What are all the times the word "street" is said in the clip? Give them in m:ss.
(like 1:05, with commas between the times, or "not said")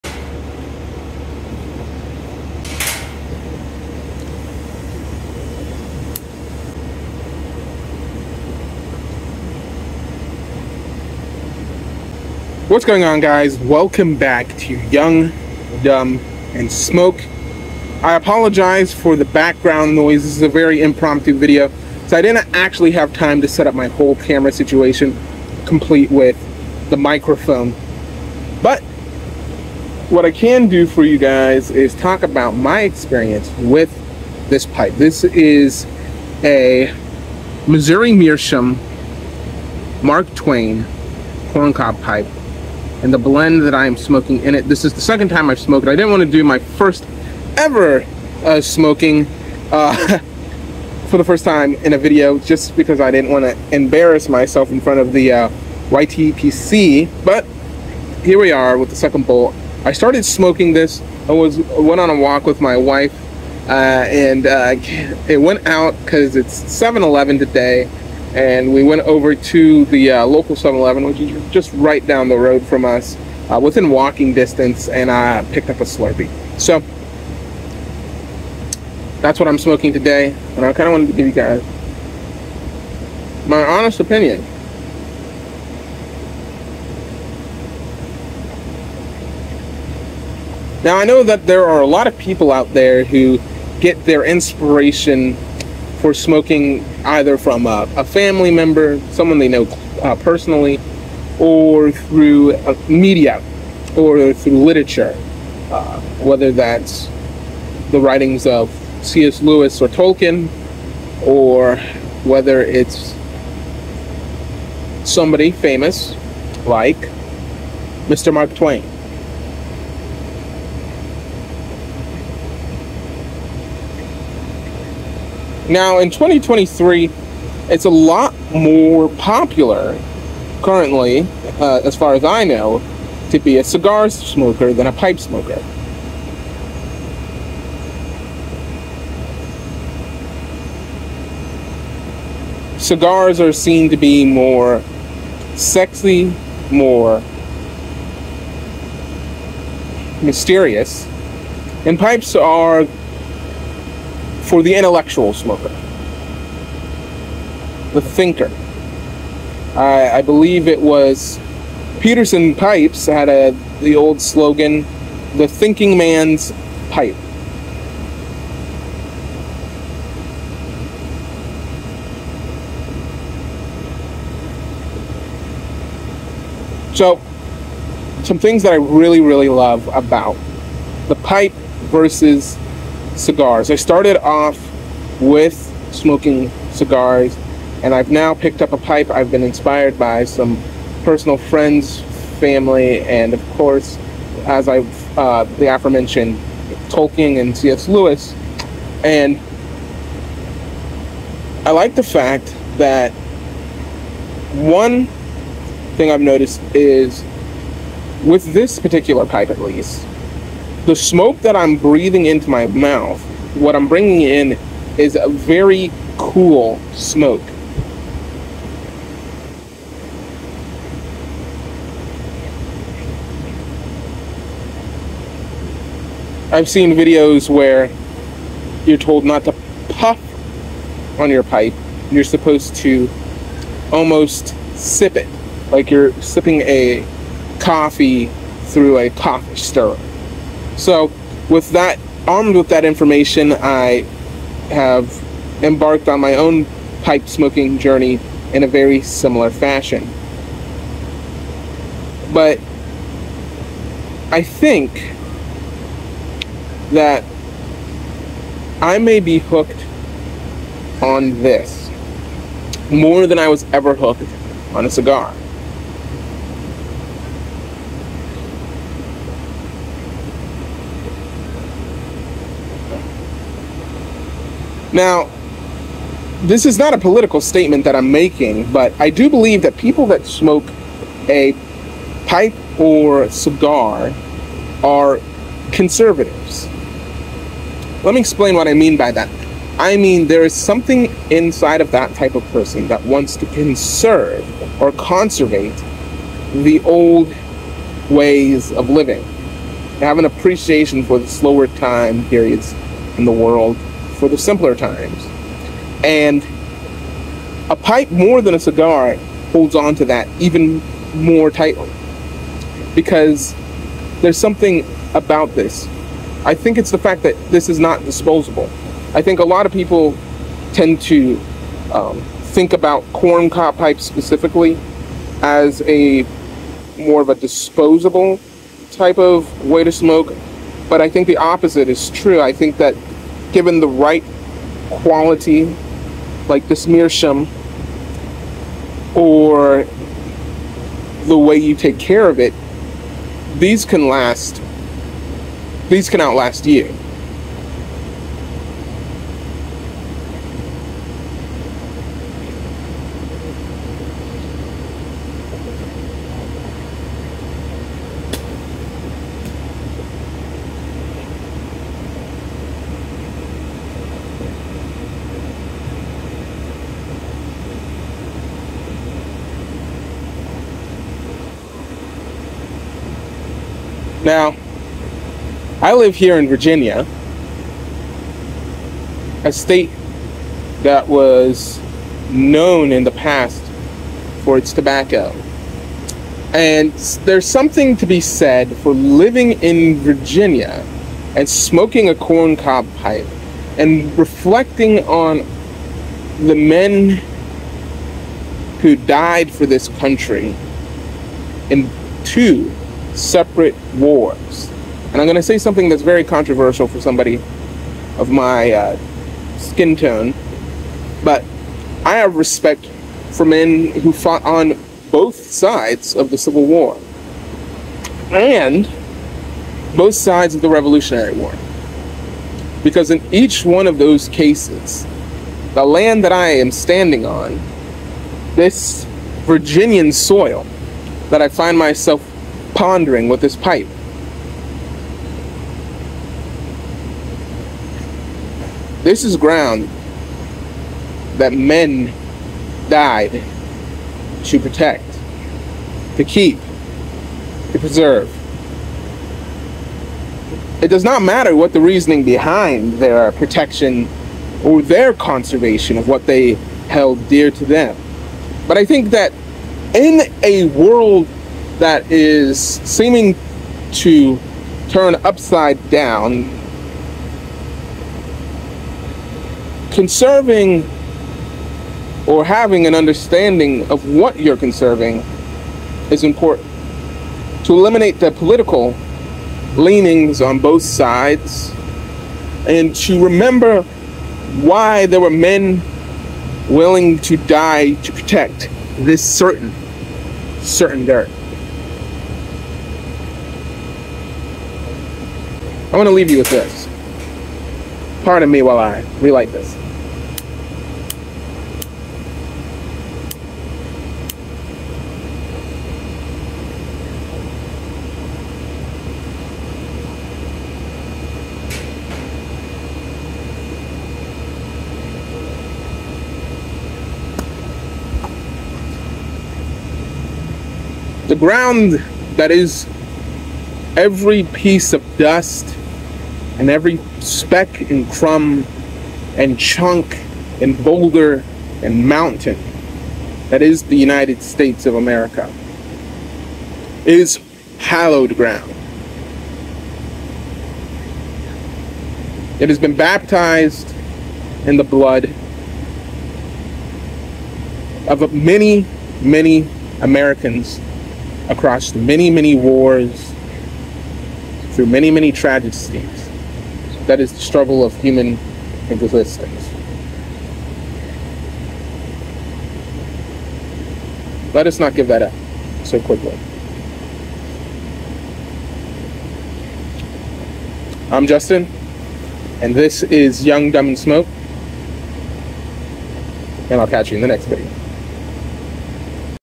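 not said.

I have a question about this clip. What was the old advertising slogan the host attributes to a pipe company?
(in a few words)
The thinking man's pipe.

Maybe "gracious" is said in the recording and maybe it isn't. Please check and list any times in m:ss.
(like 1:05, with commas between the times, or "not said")
not said.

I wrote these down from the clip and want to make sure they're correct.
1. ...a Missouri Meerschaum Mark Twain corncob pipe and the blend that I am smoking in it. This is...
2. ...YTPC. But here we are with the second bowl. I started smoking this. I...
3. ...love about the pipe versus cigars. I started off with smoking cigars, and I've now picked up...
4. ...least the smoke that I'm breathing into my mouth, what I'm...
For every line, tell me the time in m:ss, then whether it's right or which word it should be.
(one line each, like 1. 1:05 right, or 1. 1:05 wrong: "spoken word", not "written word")
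1. 0:36 right
2. 0:55 right
3. 2:59 right
4. 3:29 right.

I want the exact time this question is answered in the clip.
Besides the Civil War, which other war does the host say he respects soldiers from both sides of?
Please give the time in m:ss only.
7:00.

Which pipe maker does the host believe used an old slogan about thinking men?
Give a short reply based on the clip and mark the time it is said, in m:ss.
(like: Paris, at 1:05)
Peterson Pipes, at 2:42.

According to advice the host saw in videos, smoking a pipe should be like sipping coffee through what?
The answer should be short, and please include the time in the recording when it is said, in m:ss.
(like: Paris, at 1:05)
A coffee stirrer, at 3:59.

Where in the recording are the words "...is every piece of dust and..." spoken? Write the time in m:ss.
8:42.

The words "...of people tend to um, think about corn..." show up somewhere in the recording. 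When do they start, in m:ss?
5:19.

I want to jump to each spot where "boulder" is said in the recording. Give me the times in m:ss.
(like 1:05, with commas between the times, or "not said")
8:50.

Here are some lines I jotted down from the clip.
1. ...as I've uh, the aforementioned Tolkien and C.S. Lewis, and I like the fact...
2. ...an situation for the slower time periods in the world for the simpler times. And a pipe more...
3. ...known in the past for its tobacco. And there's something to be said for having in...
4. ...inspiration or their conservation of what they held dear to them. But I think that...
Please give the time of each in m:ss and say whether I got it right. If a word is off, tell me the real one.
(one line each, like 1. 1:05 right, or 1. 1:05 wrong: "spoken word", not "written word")
1. 3:14 right
2. 5:00 wrong: "appreciation", not "situation"
3. 6:22 wrong: "living", not "having"
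4. 7:33 wrong: "protection", not "inspiration".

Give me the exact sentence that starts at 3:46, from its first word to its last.
I've seen videos where you're told not to puff on your pipe.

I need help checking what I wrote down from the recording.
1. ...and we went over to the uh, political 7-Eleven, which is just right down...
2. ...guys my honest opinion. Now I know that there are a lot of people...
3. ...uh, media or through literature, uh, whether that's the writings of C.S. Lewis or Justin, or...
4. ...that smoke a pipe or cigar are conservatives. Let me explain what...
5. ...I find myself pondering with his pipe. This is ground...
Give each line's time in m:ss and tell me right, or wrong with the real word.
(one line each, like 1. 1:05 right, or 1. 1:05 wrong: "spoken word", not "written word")
1. 1:08 wrong: "local", not "political"
2. 1:21 right
3. 1:42 wrong: "Tolkien", not "Justin"
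4. 4:40 right
5. 7:11 right.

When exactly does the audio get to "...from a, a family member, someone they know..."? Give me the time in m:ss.
1:37.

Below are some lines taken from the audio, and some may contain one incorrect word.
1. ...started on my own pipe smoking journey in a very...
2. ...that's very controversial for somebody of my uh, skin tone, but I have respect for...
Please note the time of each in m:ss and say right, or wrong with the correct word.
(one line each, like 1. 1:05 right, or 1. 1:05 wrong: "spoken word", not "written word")
1. 4:05 wrong: "embarked", not "started"
2. 6:45 right.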